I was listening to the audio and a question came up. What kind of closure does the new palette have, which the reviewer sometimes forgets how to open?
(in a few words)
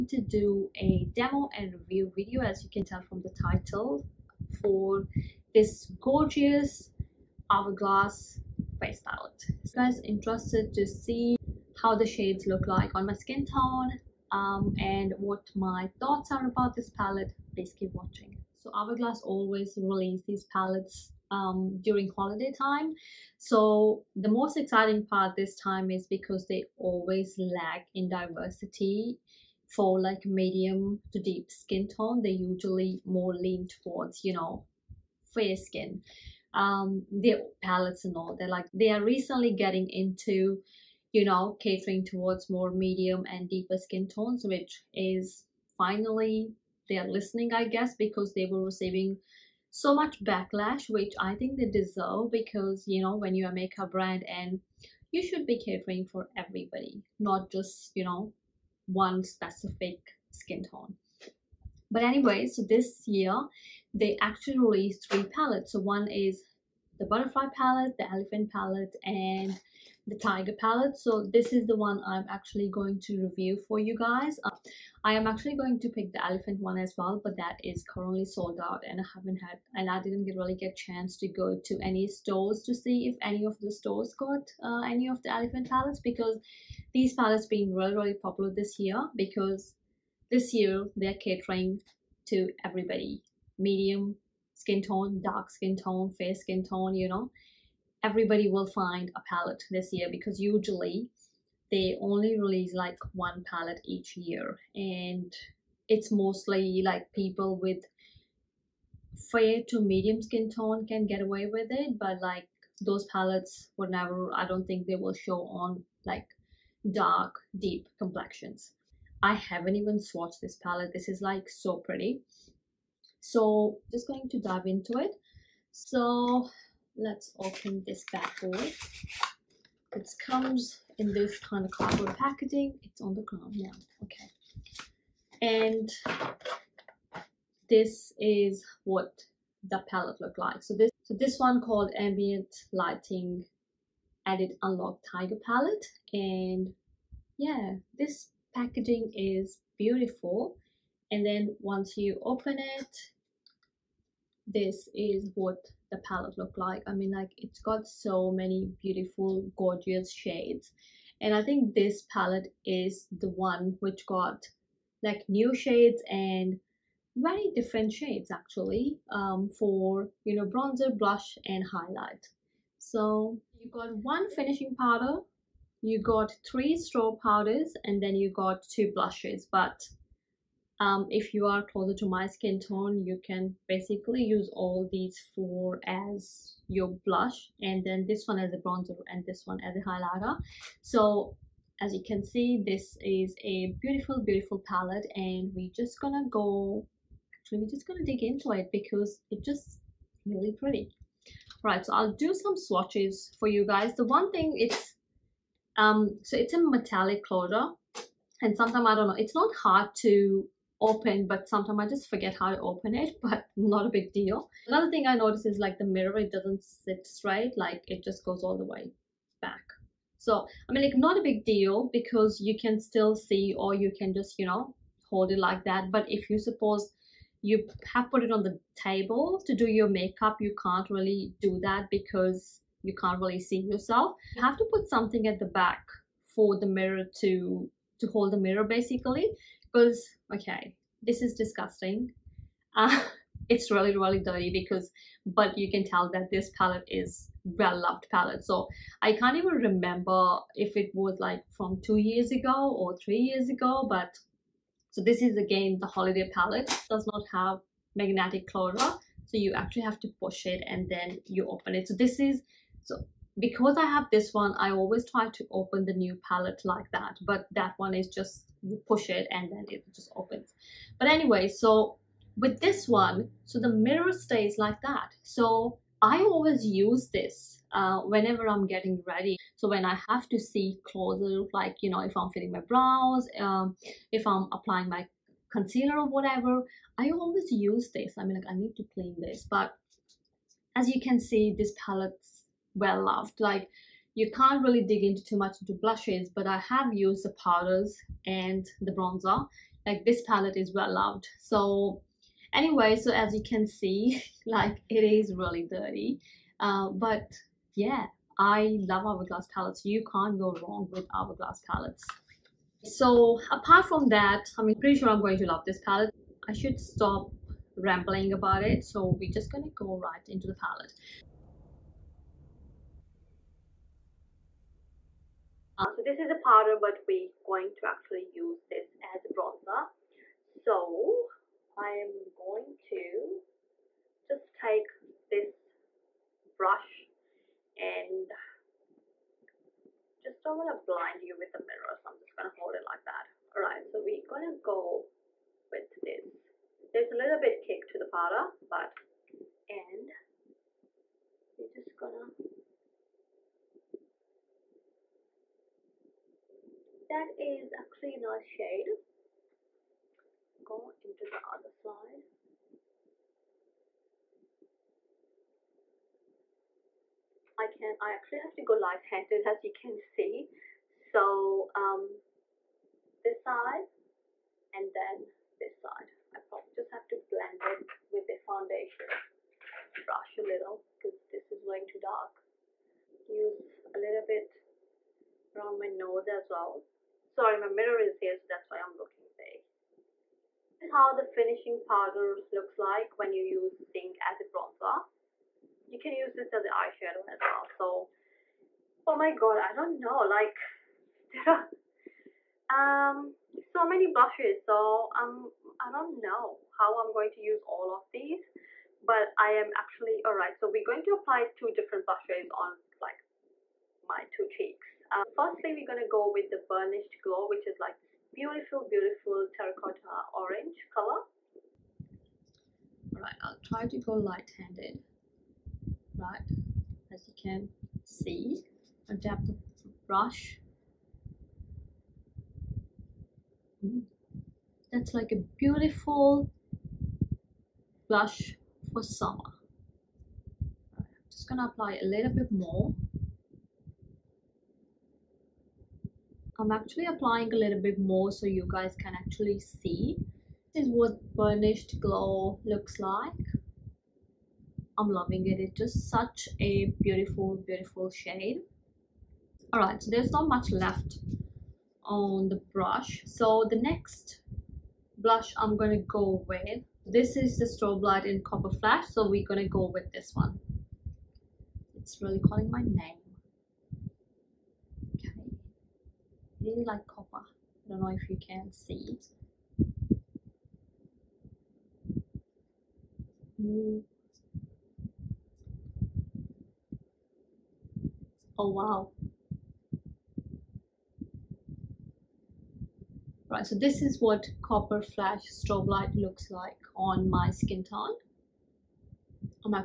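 Metallic closure.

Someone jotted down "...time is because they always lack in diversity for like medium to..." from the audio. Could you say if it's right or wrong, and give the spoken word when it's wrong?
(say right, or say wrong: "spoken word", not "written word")
right.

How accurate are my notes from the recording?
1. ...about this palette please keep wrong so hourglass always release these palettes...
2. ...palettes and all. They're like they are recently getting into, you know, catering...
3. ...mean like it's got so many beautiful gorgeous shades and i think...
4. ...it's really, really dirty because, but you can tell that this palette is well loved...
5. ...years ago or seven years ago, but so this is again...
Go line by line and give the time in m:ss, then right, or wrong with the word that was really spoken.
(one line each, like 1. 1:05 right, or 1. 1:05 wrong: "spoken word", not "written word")
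1. 0:16 wrong: "watching", not "wrong"
2. 0:37 right
3. 2:36 right
4. 4:03 right
5. 4:11 wrong: "three", not "seven".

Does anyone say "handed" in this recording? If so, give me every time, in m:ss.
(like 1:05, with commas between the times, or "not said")
6:08, 7:04.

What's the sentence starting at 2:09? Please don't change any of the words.
It comes in this kind of cardboard packaging.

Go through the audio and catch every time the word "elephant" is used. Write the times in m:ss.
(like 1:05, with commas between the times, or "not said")
1:08, 1:16, 1:25.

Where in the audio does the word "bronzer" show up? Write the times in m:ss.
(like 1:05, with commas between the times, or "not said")
2:50, 3:08, 4:58, 5:29, 6:34.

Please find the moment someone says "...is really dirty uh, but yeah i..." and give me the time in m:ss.
5:05.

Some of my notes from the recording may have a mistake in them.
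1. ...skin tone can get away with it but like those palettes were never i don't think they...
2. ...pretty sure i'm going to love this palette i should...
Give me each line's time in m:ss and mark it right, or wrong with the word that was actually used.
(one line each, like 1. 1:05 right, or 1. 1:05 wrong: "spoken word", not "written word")
1. 1:50 right
2. 5:14 right.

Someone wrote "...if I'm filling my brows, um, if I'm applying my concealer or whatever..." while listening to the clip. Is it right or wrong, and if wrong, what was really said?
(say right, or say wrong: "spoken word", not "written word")
right.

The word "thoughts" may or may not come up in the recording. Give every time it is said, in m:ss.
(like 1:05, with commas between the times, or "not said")
0:15.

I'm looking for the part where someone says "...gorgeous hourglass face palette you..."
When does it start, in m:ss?
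0:05.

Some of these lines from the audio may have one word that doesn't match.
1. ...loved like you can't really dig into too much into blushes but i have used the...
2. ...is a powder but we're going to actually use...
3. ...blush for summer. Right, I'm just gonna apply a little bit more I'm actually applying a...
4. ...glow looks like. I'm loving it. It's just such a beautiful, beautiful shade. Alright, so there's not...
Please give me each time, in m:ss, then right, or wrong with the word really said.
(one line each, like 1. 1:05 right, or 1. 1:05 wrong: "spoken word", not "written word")
1. 4:53 right
2. 5:26 right
3. 7:18 right
4. 7:31 right.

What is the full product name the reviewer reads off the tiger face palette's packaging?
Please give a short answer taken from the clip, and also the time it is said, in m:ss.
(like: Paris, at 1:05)
Ambient Lighting Edit Unlock Tiger Palette, at 2:21.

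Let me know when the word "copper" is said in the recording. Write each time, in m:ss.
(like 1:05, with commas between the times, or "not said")
7:48, 7:57, 8:14.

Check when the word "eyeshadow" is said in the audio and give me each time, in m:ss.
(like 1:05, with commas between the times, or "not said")
6:36.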